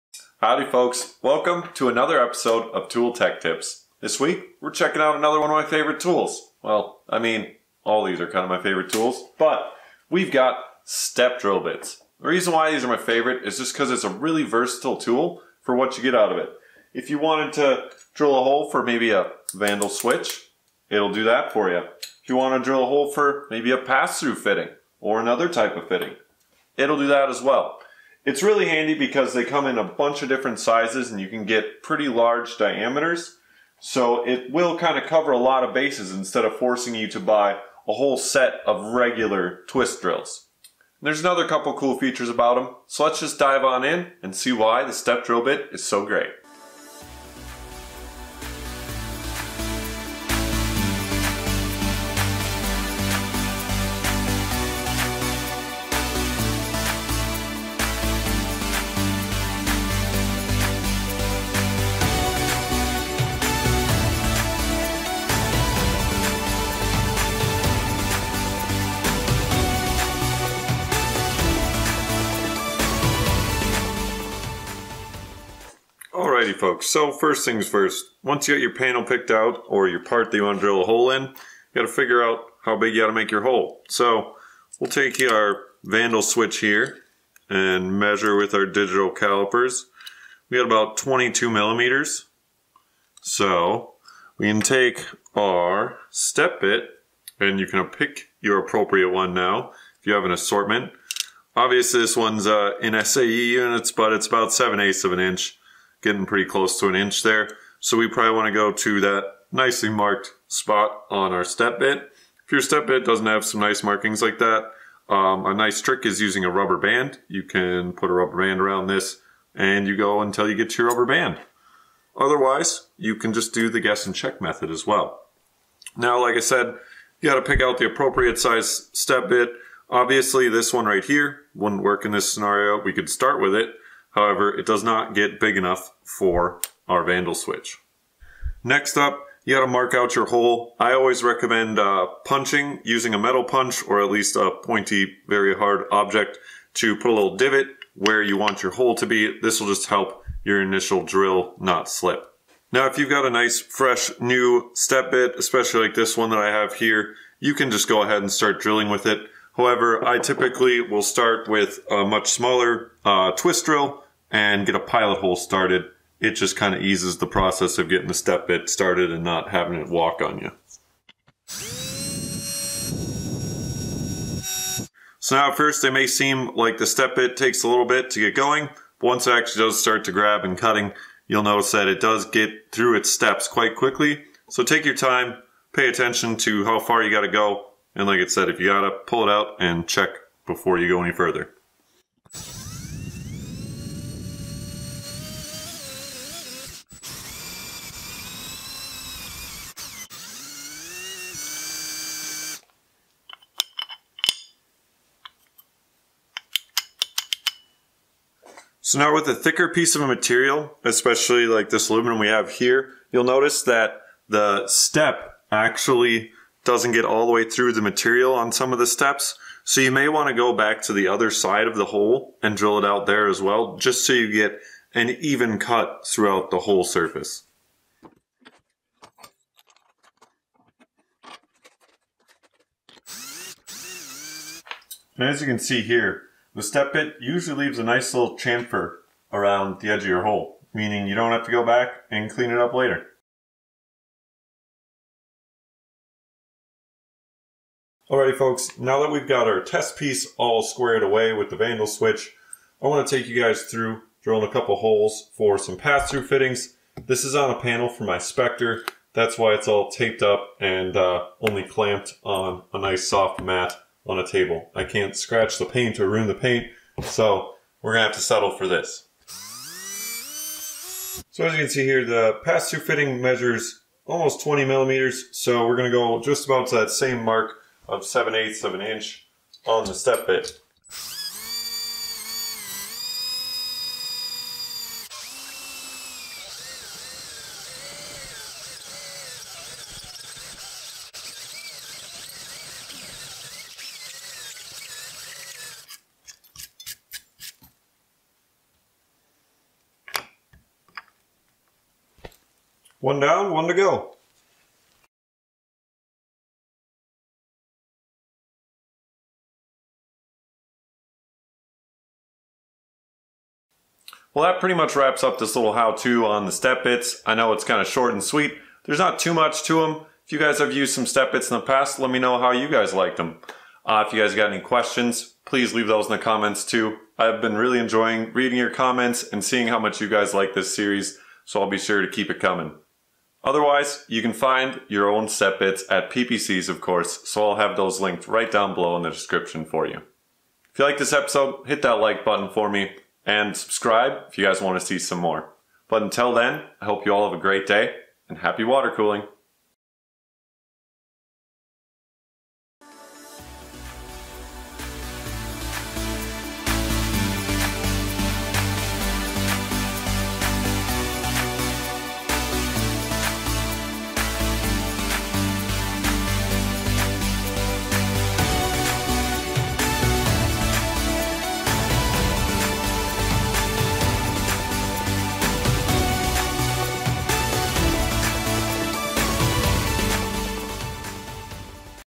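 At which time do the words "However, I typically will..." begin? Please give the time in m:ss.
2:39.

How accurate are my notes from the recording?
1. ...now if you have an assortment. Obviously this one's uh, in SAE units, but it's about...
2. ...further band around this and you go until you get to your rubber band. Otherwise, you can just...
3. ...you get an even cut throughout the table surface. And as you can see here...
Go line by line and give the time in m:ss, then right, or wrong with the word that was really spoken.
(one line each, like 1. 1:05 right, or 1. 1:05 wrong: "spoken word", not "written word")
1. 1:39 right
2. 1:58 wrong: "rubber", not "further"
3. 3:44 wrong: "whole", not "table".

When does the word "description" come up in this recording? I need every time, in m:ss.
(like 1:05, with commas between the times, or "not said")
5:39.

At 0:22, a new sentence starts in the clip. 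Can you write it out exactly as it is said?
If you want to drill a hole for maybe a pass-through fitting or another type of fitting, it'll do that as well.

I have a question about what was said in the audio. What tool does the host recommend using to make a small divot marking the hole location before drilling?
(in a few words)
metal punch.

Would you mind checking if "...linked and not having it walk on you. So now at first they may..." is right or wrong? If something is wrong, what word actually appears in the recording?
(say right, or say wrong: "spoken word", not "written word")
wrong: "started", not "linked".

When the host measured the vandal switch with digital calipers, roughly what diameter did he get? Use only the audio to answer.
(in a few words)
22 millimeters.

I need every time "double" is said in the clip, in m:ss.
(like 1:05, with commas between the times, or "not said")
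not said.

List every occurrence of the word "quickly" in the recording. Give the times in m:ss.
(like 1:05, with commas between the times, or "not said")
3:03.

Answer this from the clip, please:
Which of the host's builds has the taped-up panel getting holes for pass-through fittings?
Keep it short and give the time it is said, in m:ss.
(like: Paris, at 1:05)
Spectre, at 4:18.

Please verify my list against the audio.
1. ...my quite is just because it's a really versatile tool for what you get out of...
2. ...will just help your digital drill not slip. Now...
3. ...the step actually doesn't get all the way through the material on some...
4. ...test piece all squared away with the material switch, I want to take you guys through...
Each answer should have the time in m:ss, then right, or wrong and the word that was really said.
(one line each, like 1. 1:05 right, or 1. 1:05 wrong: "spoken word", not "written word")
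1. 0:12 wrong: "favorite", not "quite"
2. 2:29 wrong: "initial", not "digital"
3. 3:34 right
4. 4:09 wrong: "vandal", not "material".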